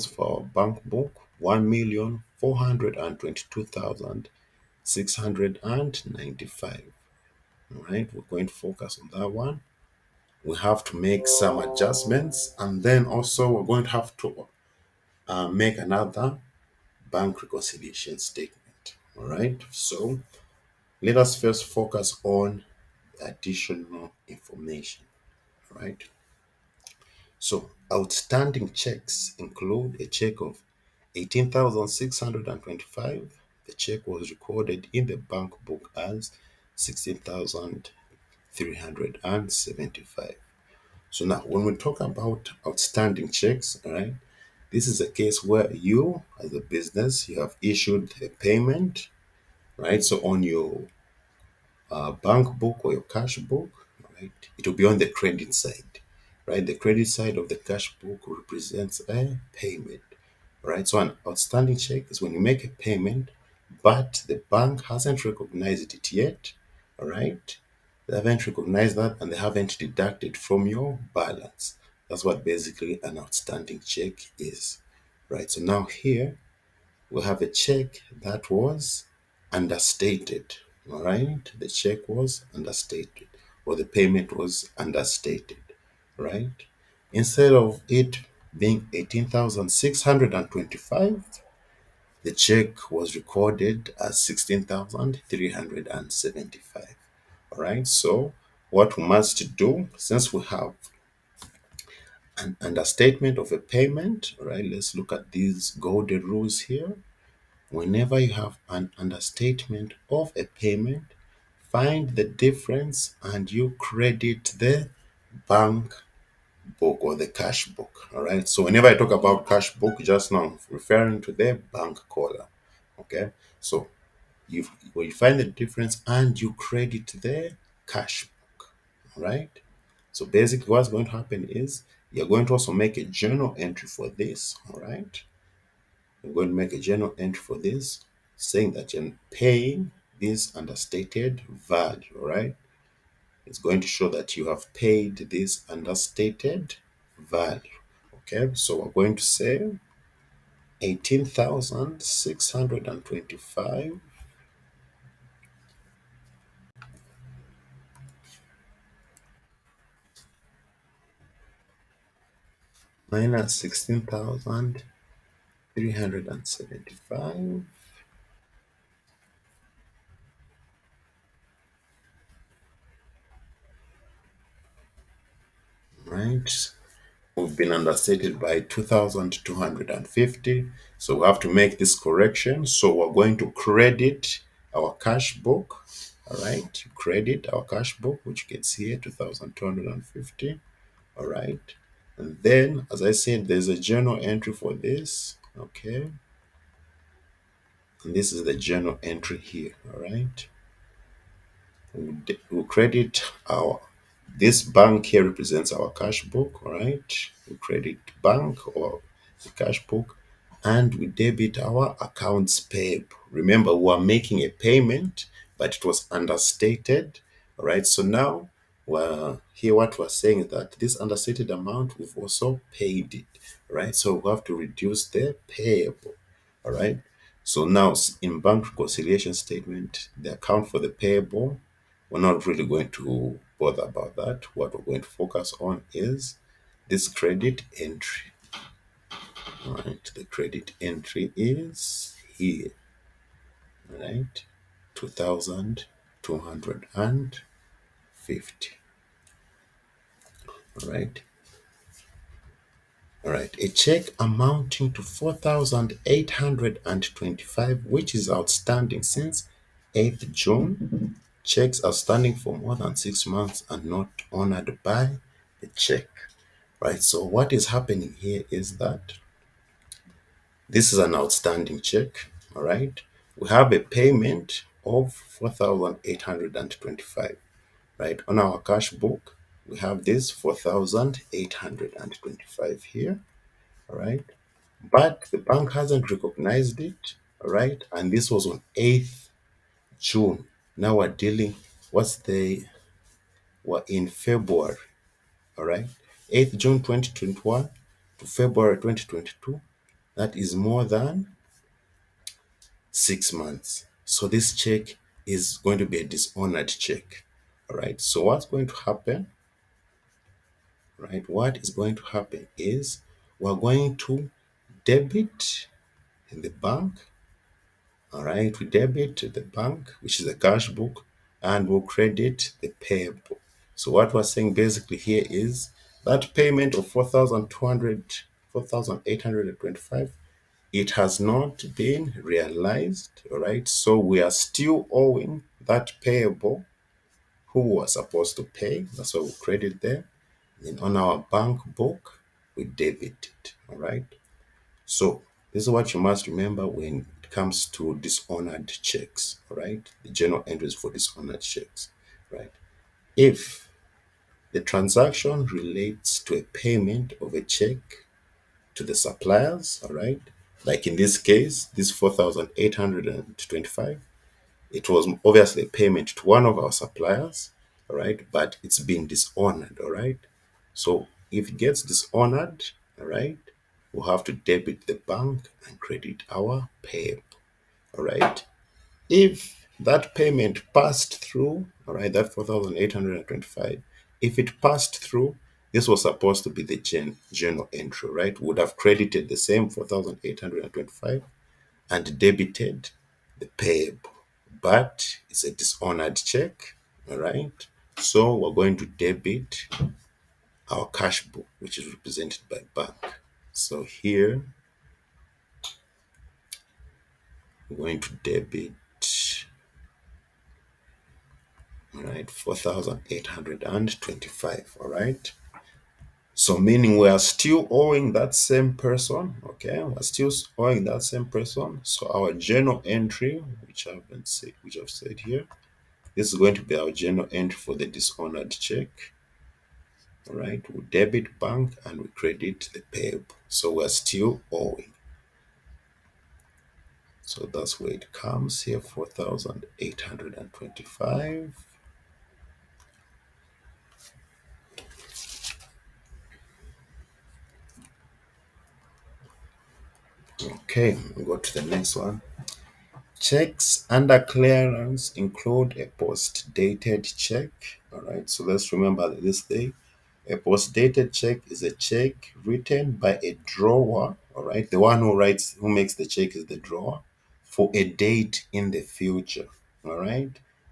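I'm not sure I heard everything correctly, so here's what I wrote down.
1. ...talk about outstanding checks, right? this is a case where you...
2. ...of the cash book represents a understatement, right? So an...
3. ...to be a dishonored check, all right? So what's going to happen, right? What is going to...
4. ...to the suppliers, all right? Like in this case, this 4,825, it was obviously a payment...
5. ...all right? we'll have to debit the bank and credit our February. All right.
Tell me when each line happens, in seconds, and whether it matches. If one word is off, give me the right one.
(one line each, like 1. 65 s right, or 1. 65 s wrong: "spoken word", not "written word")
1. 41 s right
2. 57 s wrong: "payment", not "understatement"
3. 305 s right
4. 358 s right
5. 372 s wrong: "PEP", not "February".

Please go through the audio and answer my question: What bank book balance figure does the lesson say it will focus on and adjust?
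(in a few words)
1,422,695.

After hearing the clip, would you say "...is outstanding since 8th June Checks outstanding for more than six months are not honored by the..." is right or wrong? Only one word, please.
right.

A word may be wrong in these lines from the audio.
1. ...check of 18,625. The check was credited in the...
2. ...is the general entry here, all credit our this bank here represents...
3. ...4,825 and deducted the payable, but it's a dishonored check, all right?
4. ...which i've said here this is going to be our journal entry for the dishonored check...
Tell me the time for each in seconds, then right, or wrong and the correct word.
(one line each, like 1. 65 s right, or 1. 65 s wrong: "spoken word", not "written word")
1. 30 s wrong: "recorded", not "credited"
2. 198 s wrong: "journal", not "general"
3. 389 s wrong: "debited", not "deducted"
4. 424 s right.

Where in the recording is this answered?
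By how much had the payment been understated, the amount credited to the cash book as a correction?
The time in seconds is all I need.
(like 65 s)
177 s.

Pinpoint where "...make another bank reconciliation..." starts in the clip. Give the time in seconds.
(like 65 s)
15 s.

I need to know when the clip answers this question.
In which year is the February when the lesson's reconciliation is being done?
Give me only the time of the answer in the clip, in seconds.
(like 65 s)
298 s.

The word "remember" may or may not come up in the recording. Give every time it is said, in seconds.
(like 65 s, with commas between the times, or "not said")
213 s, 346 s, 458 s.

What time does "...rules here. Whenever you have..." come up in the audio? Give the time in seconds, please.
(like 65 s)
106 s.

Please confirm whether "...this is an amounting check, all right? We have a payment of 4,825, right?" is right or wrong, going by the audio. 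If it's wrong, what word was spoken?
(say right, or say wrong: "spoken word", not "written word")
wrong: "outstanding", not "amounting".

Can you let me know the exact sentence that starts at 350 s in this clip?
The general entries for dishonored checks, right?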